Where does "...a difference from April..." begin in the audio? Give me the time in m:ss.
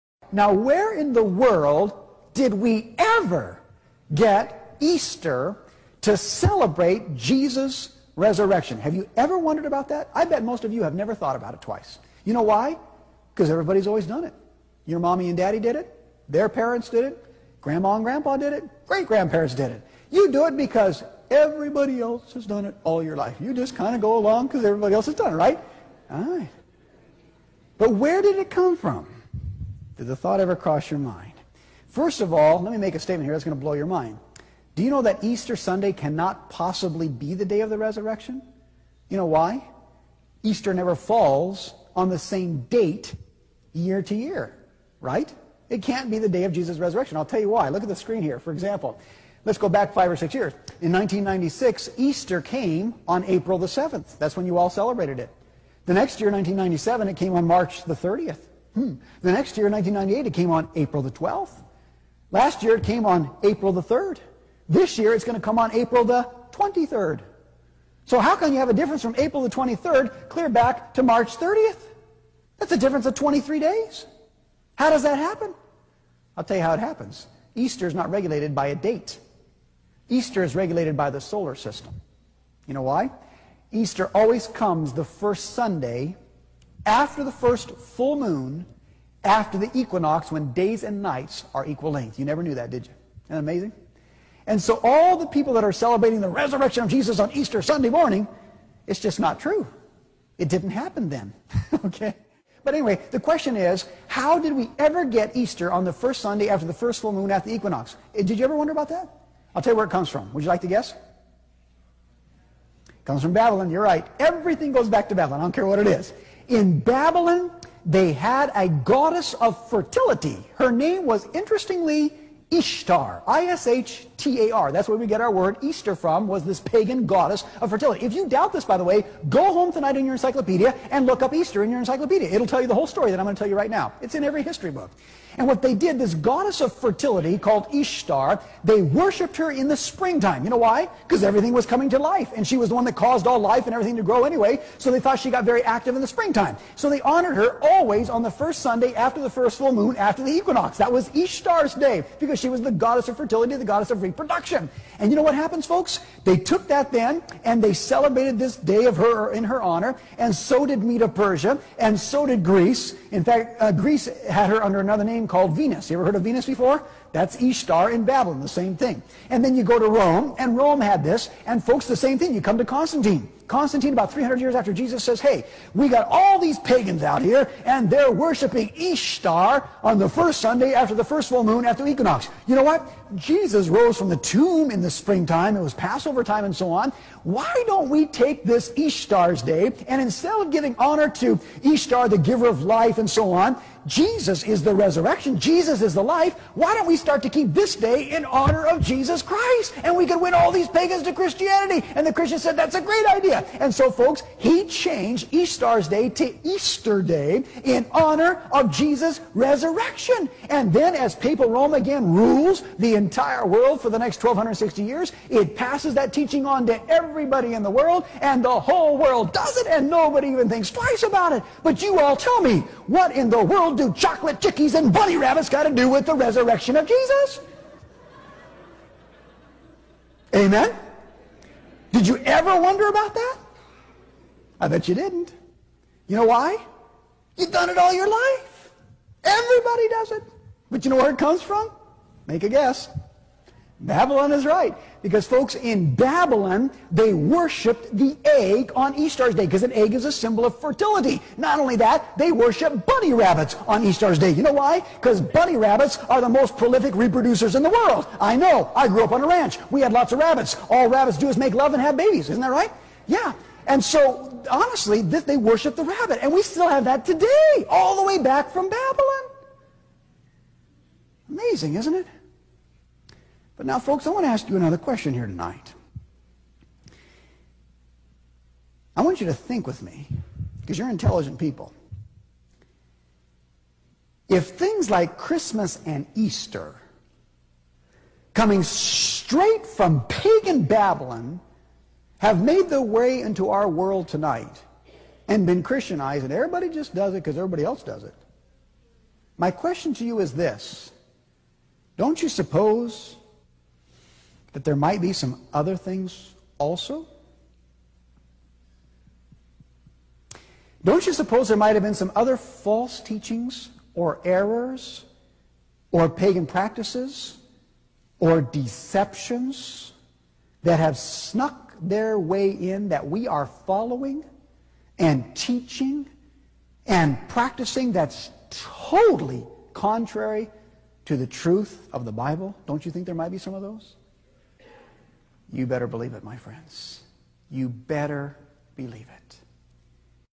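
1:08.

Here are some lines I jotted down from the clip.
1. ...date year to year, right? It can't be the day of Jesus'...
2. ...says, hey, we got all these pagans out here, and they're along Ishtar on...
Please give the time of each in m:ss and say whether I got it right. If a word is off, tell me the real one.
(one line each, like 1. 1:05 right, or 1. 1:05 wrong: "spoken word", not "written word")
1. 0:42 right
2. 2:55 wrong: "worshiping", not "along".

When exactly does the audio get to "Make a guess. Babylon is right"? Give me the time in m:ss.
4:02.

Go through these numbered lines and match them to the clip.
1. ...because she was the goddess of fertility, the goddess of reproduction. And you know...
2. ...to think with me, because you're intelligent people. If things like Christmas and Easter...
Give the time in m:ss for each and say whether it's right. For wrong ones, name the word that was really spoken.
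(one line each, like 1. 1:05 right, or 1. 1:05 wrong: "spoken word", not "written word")
1. 2:32 right
2. 4:39 right.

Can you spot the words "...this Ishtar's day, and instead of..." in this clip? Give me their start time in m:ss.
3:08.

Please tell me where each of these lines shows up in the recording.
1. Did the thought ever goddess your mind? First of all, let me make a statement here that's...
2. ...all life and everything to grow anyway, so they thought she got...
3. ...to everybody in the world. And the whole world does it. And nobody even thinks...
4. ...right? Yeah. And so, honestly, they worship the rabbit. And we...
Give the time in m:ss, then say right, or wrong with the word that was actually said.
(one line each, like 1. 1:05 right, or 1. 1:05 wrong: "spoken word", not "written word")
1. 0:30 wrong: "cross", not "goddess"
2. 2:23 right
3. 3:36 right
4. 4:22 right.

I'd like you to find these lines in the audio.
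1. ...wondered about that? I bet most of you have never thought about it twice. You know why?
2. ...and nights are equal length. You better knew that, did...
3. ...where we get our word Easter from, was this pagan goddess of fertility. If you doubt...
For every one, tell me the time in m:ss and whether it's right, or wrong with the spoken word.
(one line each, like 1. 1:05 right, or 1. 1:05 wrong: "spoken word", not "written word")
1. 0:09 right
2. 1:30 wrong: "never", not "better"
3. 2:04 right.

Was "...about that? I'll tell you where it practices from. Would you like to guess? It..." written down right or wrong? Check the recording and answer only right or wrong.
wrong.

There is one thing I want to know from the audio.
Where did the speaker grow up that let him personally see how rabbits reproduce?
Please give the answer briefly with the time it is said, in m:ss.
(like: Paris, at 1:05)
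a ranch, at 4:19.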